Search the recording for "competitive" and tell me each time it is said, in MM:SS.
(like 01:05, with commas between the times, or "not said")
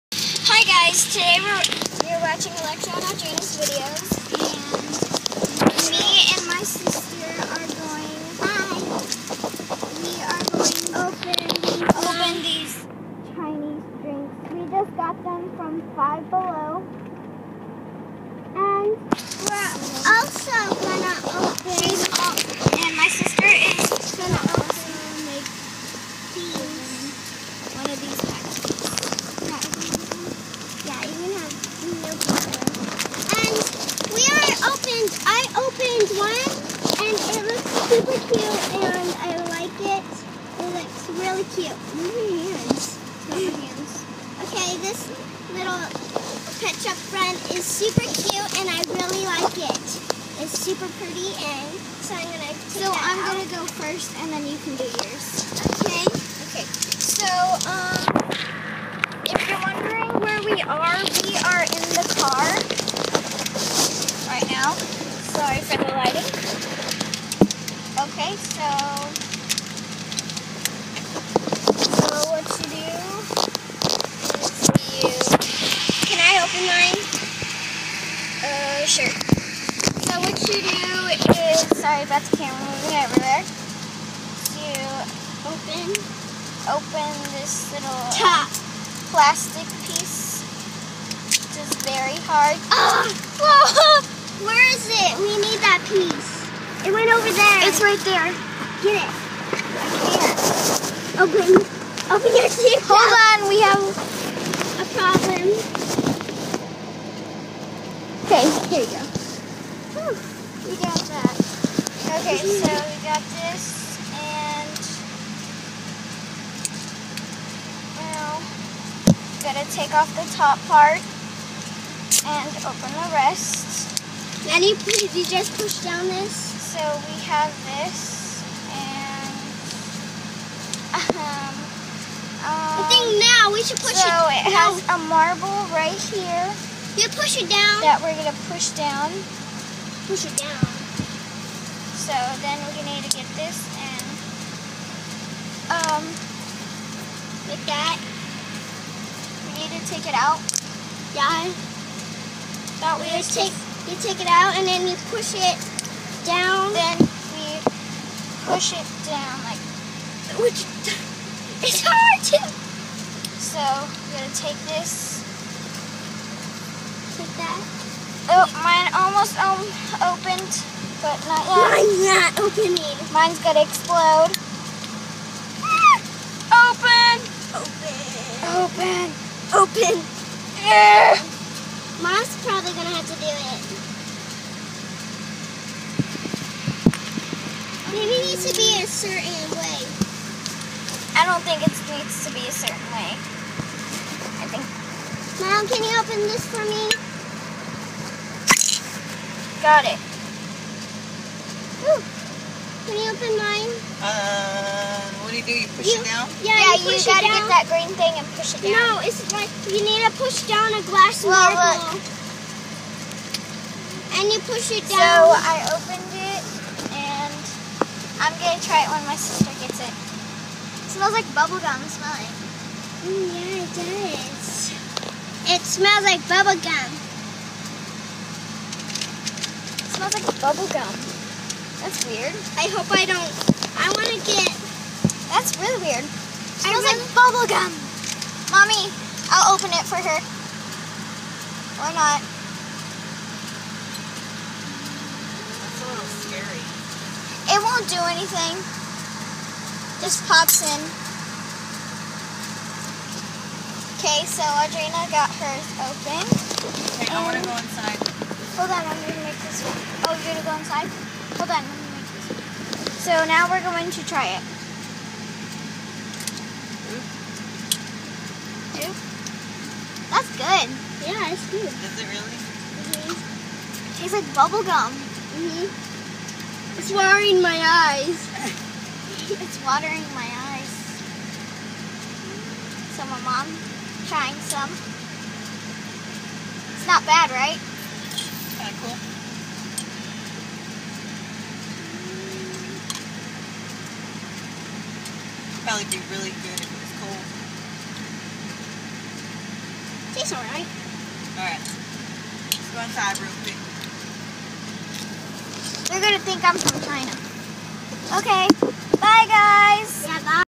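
not said.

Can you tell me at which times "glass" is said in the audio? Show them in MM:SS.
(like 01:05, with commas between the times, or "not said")
03:30.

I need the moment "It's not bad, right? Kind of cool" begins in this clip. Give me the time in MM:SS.
04:46.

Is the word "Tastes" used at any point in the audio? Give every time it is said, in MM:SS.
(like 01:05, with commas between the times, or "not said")
04:34, 05:00.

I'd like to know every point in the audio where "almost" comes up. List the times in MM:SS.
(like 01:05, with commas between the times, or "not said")
02:48.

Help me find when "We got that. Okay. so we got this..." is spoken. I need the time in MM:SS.
01:50.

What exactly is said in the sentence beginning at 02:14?
So it has a marble right here.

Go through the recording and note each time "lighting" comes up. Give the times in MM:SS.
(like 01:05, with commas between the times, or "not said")
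01:05.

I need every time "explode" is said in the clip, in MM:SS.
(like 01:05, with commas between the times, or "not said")
02:53.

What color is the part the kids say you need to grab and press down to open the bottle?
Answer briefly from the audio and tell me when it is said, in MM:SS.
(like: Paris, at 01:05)
green, at 03:27.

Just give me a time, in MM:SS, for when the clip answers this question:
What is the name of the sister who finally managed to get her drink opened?
04:14.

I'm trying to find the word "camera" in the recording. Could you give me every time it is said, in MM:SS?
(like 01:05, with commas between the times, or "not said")
01:22.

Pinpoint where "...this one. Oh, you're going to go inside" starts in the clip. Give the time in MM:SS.
04:19.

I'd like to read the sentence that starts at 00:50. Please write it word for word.
It's super pretty, and so I'm gonna.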